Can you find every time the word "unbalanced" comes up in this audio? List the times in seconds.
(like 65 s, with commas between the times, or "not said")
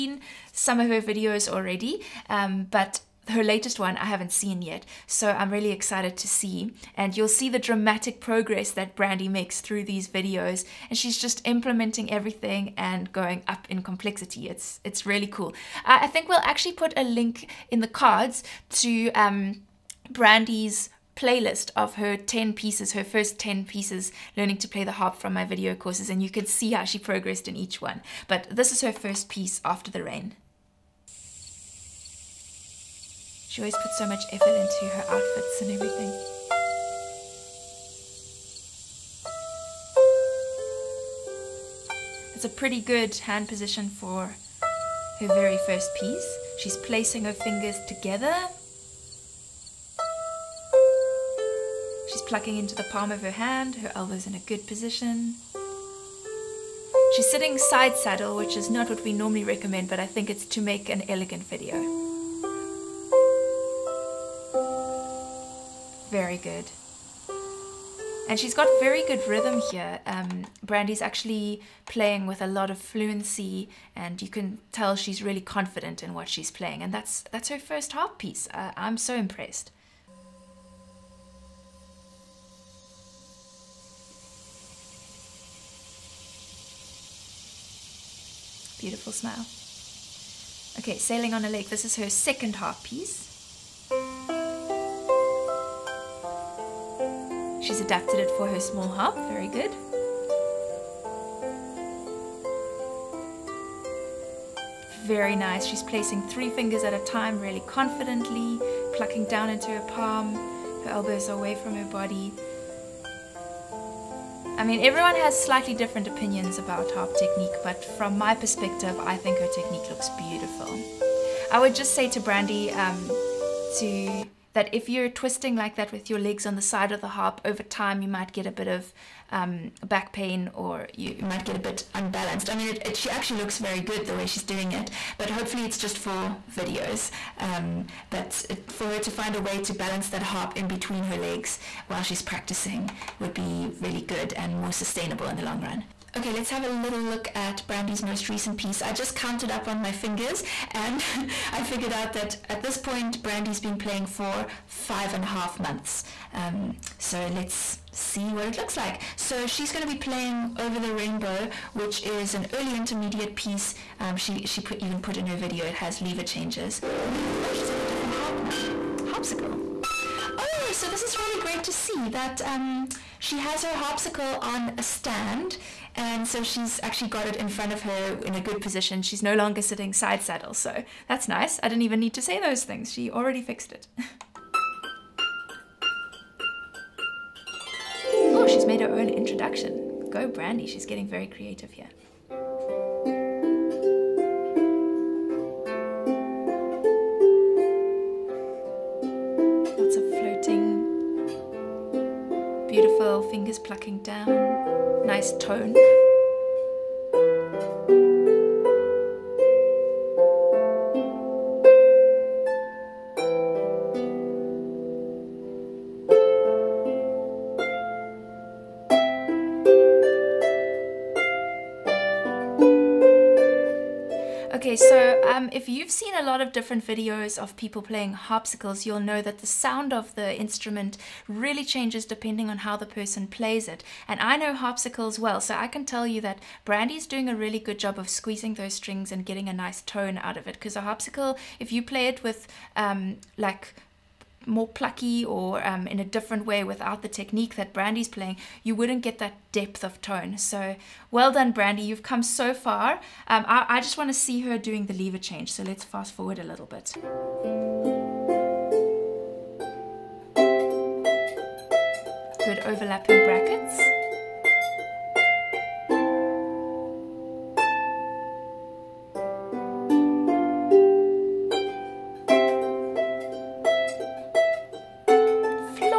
131 s.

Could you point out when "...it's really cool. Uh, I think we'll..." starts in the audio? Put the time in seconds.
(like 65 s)
14 s.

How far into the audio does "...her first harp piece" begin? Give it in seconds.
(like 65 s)
77 s.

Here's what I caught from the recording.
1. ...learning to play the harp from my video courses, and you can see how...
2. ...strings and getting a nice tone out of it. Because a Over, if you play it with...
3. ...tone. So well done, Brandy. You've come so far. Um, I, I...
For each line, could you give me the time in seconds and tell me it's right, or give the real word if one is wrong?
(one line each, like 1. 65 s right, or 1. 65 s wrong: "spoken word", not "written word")
1. 24 s right
2. 238 s wrong: "Harpsicle", not "Over"
3. 250 s right.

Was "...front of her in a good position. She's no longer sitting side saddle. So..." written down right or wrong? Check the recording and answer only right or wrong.
right.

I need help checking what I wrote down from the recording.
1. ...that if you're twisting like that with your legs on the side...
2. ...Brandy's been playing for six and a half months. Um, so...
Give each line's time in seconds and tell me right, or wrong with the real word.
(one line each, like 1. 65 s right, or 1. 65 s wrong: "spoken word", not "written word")
1. 124 s right
2. 153 s wrong: "five", not "six".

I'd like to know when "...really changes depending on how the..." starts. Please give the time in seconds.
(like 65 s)
231 s.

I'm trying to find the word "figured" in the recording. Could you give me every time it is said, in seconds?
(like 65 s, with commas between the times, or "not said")
151 s.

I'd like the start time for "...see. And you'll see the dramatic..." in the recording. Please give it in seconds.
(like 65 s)
6 s.